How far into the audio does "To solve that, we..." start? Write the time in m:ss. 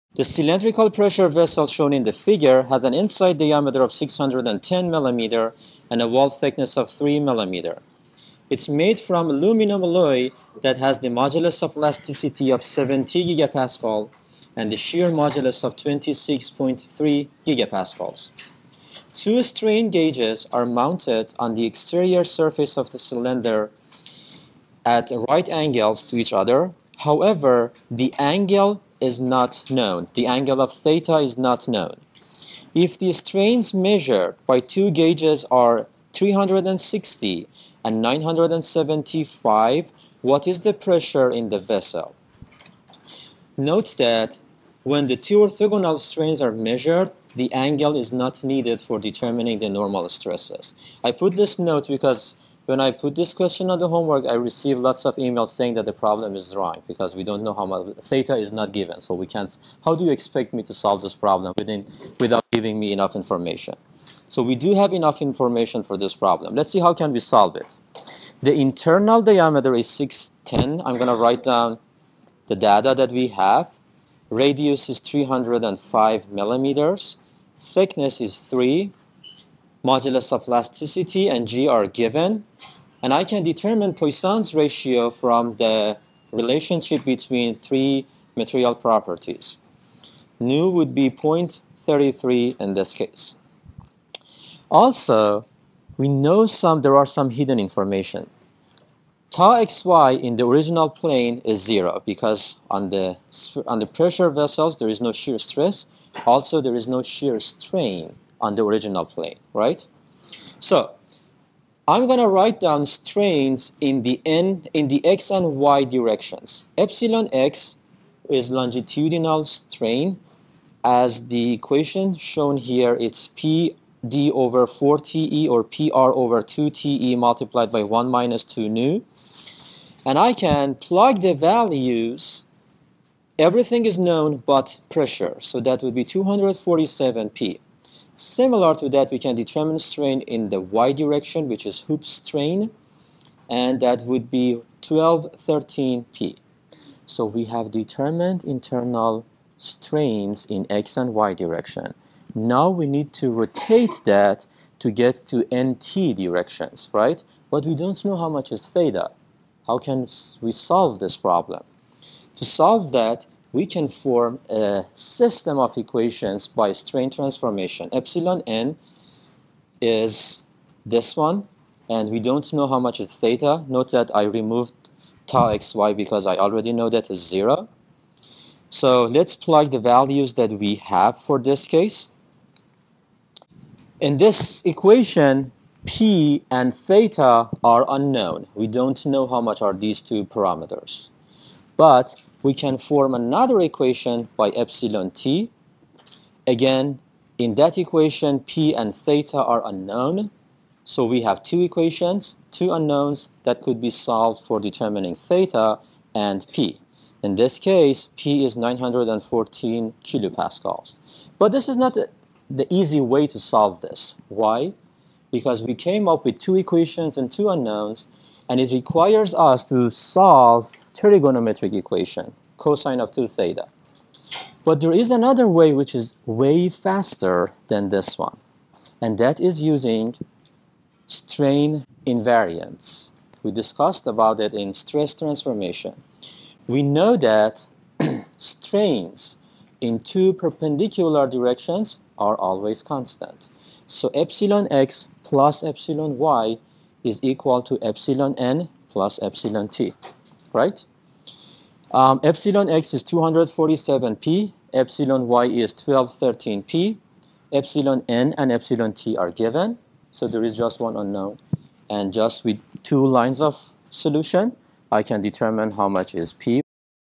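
2:42.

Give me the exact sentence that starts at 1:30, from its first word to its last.
Nu would be 0.33 in this case.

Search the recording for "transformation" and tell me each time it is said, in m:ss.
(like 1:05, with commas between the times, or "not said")
2:47, 3:55.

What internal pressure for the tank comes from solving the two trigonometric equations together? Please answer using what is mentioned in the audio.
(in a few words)
914 kPa.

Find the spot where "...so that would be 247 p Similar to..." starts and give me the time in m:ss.
2:15.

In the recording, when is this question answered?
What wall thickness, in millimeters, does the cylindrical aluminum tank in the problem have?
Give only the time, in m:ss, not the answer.
0:06.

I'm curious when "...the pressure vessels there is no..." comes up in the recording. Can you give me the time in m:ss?
1:43.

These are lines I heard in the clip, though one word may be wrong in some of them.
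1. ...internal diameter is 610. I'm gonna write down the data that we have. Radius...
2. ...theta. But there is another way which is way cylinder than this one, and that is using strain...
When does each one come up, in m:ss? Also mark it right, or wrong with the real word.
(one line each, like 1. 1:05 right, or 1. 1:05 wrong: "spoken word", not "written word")
1. 1:08 right
2. 3:43 wrong: "faster", not "cylinder".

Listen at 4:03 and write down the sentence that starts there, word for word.
So epsilon x plus epsilon y is equal to epsilon n plus epsilon t right?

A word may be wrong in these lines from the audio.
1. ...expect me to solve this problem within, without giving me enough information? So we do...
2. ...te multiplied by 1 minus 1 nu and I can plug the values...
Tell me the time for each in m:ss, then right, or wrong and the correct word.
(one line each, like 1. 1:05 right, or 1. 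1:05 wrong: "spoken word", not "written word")
1. 1:00 right
2. 2:06 wrong: "2", not "1".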